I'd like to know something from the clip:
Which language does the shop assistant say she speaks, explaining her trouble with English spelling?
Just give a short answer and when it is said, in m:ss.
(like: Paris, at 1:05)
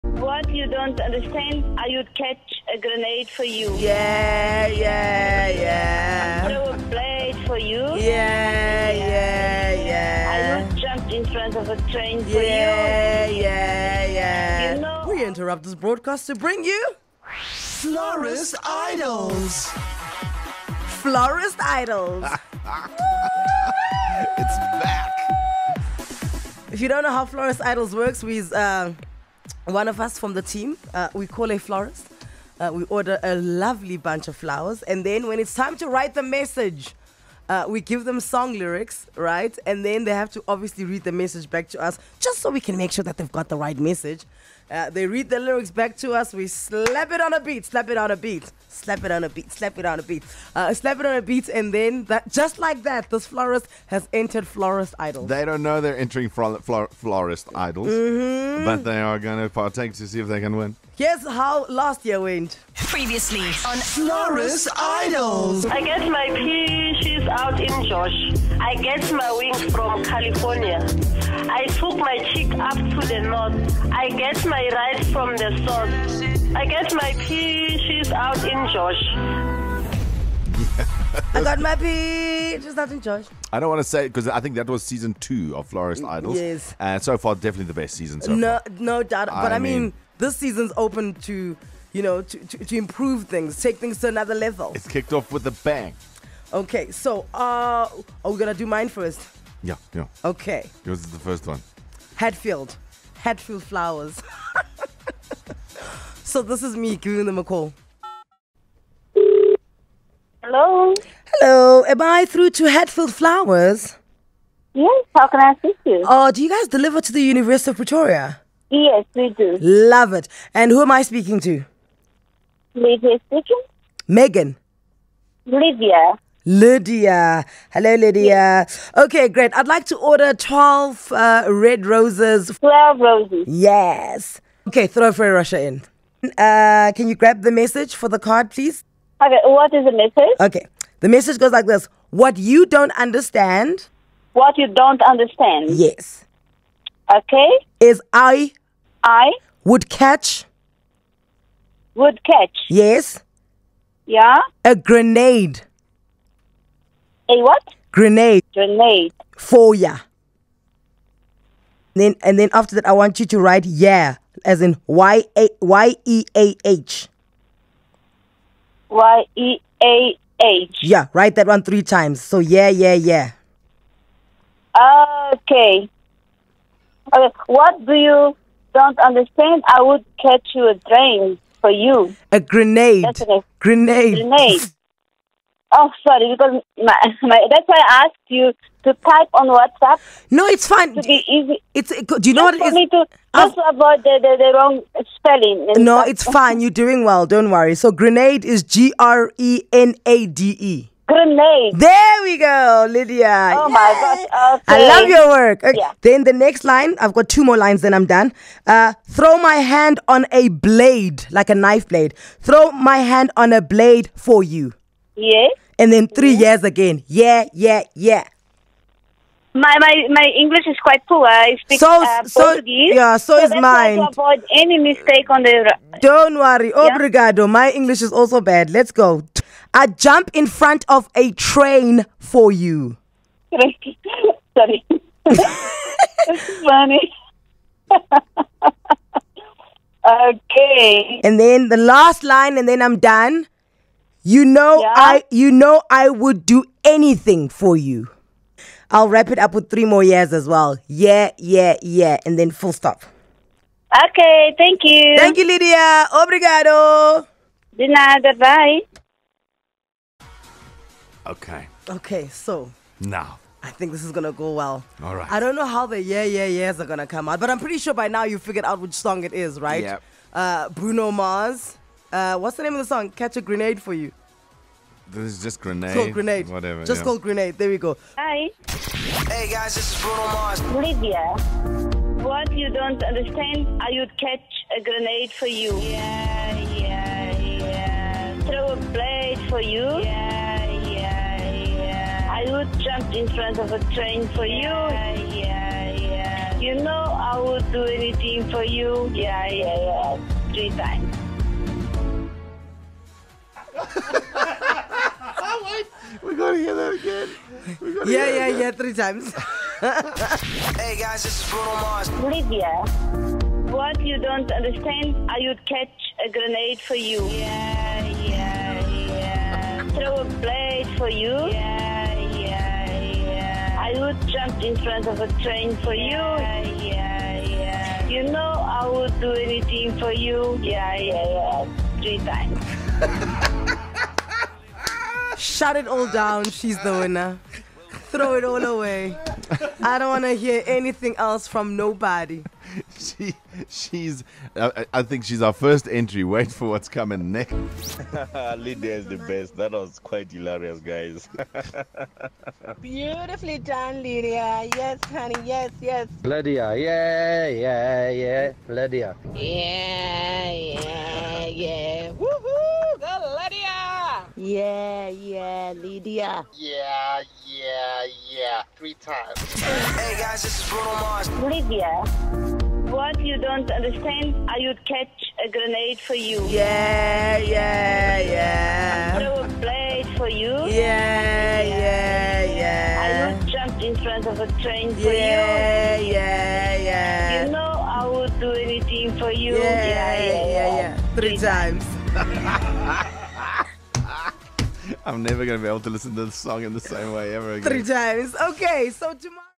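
Portuguese, at 3:42.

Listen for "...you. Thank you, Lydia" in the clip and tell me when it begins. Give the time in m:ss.
4:14.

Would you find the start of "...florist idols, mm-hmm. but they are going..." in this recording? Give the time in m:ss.
0:56.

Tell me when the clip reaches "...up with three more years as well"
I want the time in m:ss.
4:09.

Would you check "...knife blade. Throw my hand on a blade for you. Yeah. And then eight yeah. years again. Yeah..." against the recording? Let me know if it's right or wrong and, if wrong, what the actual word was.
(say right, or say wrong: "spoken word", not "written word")
wrong: "three", not "eight".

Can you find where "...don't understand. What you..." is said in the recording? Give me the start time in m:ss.
2:22.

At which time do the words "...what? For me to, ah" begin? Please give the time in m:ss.
3:12.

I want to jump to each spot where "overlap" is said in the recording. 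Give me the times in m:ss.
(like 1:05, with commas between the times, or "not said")
not said.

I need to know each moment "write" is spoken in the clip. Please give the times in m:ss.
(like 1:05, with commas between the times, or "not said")
0:35, 2:43, 2:51.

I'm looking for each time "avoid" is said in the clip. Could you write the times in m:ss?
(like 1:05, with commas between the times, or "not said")
3:44.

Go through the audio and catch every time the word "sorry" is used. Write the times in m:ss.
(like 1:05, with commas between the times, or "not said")
3:06, 3:53.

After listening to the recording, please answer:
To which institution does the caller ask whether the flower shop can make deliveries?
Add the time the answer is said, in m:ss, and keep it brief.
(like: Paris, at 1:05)
University of Pretoria, at 1:57.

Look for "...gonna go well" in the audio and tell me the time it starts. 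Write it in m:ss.
4:24.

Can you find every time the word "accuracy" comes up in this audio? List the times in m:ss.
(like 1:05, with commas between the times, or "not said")
not said.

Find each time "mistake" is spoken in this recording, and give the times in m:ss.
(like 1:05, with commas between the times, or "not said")
3:44.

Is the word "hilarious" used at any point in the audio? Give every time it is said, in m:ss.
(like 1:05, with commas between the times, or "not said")
5:50.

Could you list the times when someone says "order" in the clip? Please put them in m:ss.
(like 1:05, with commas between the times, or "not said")
0:32, 2:09.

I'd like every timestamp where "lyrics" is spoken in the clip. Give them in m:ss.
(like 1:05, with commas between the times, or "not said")
0:38, 0:45.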